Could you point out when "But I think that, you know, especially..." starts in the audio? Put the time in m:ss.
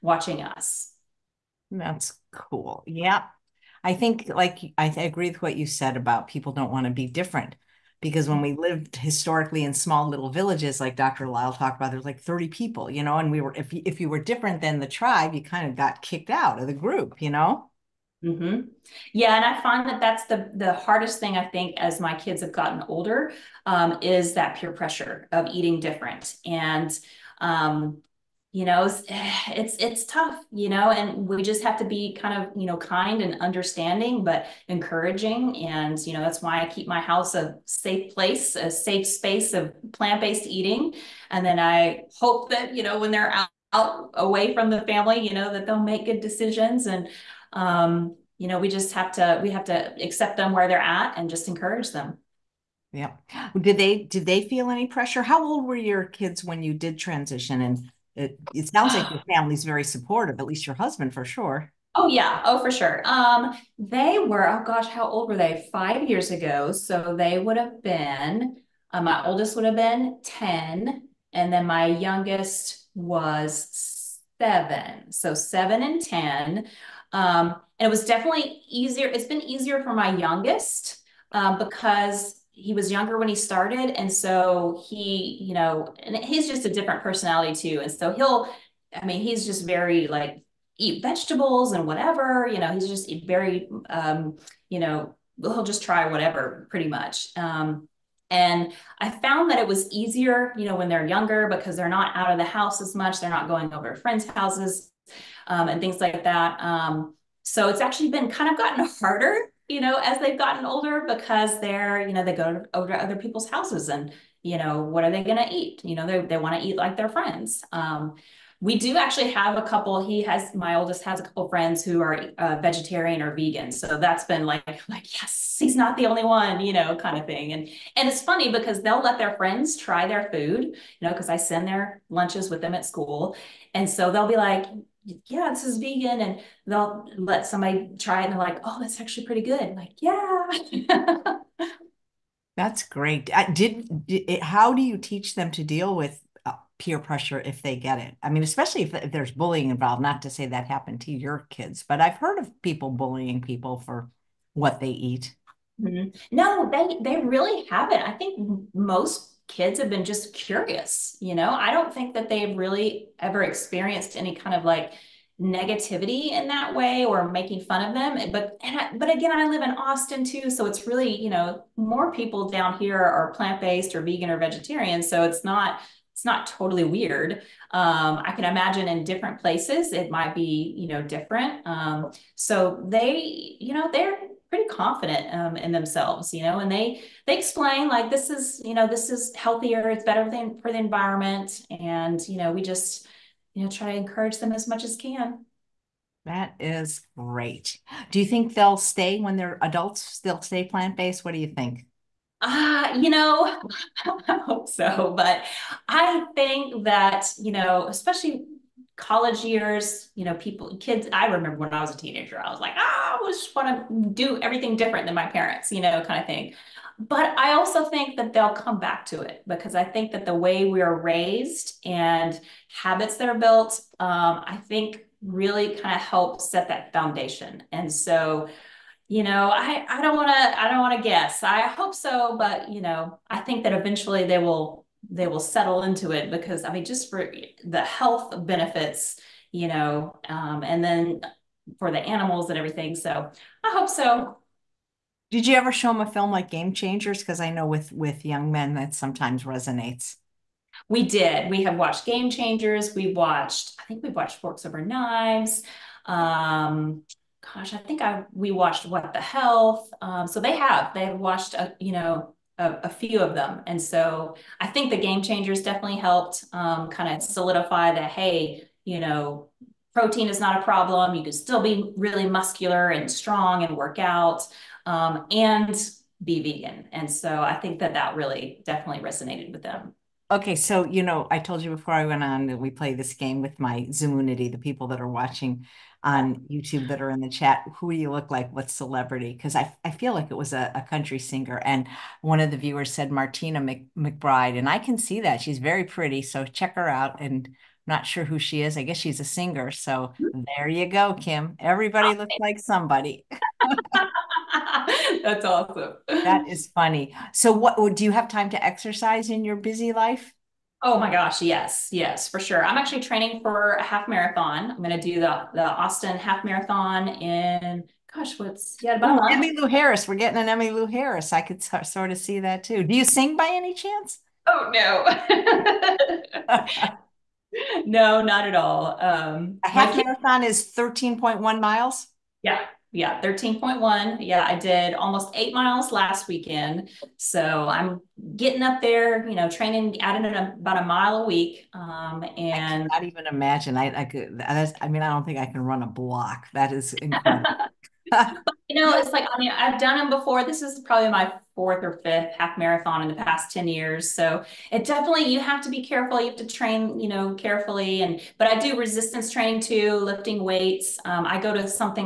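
3:25.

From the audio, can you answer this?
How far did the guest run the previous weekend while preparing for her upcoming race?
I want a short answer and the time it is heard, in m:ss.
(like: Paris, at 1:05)
almost 8 miles, at 5:34.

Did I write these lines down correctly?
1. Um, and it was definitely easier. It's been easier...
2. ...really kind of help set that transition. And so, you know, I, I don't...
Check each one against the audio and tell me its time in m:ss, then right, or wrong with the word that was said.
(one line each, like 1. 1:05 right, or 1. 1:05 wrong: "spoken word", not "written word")
1. 1:17 right
2. 3:45 wrong: "foundation", not "transition".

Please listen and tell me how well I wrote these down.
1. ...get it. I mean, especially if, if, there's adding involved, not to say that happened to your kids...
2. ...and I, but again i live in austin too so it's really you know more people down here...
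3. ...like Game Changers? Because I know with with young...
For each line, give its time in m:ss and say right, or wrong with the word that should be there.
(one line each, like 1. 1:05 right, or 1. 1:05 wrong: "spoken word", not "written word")
1. 2:27 wrong: "bullying", not "adding"
2. 2:48 right
3. 4:06 right.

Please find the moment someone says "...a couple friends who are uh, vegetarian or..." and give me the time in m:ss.
2:01.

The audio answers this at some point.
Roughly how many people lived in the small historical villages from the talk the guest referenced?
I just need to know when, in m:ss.
0:12.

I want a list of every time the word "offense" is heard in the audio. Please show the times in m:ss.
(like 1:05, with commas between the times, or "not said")
not said.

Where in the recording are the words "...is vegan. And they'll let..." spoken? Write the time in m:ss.
2:15.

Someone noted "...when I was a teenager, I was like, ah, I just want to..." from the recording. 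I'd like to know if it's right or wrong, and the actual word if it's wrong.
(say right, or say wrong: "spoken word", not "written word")
right.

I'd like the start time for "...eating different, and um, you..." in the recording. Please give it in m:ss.
0:25.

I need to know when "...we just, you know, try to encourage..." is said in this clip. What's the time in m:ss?
3:12.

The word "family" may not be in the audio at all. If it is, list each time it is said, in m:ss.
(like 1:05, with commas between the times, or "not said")
0:44, 0:59.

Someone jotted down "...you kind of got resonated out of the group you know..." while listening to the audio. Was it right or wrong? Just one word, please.
wrong.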